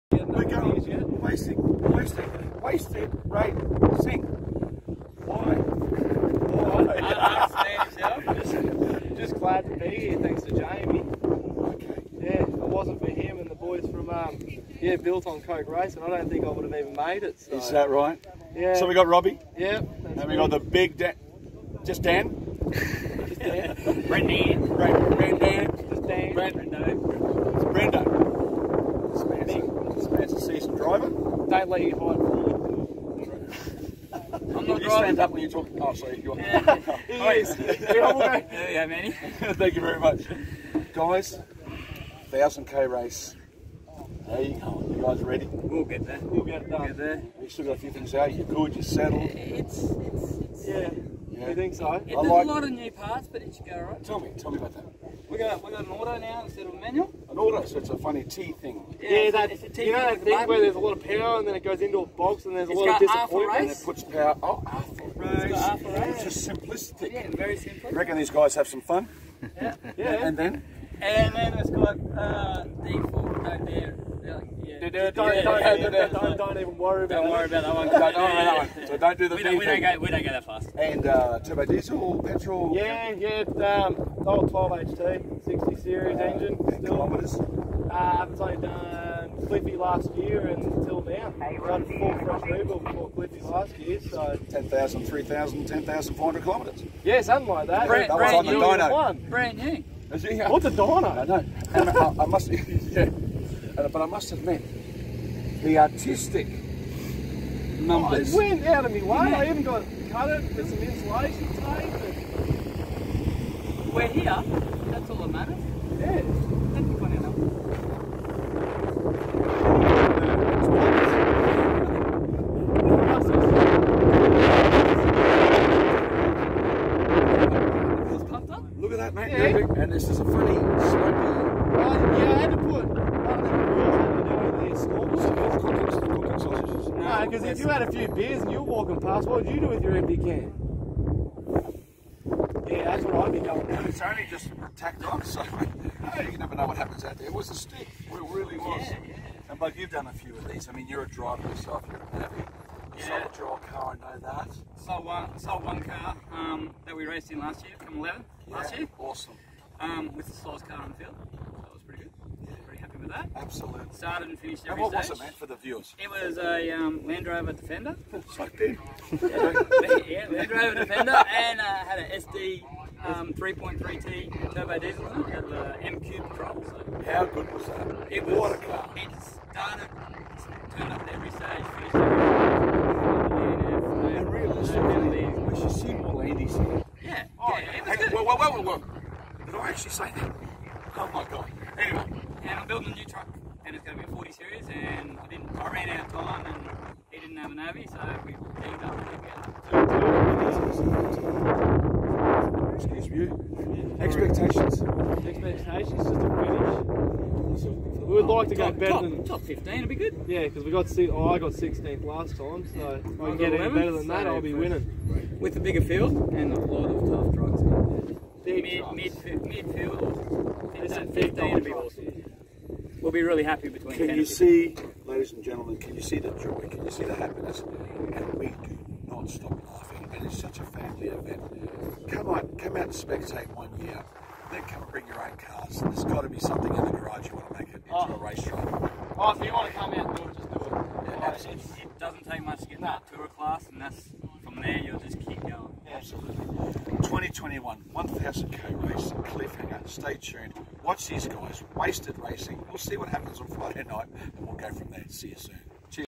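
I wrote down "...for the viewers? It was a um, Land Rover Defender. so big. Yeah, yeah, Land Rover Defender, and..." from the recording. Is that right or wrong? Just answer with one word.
right.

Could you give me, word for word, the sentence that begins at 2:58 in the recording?
It started, turned up at every stage, finished every stage.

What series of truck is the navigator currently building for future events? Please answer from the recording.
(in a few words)
40 series.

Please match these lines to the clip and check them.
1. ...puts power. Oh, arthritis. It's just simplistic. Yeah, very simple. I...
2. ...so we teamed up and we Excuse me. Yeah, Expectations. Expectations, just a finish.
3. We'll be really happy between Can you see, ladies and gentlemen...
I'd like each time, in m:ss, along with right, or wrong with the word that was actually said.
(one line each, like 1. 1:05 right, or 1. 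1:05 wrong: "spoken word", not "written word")
1. 1:03 right
2. 3:17 right
3. 3:43 right.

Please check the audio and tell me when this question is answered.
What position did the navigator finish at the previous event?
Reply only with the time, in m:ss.
3:31.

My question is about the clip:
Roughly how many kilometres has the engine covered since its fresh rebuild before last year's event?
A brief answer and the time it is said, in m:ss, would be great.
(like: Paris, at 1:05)
10,500 kilometres, at 1:35.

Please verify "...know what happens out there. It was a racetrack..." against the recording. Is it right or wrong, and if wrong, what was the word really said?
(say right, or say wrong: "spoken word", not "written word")
wrong: "stick", not "racetrack".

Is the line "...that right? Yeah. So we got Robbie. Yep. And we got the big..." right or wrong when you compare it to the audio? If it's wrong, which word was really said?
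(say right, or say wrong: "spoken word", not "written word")
right.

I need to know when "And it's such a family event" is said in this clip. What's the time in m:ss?
3:50.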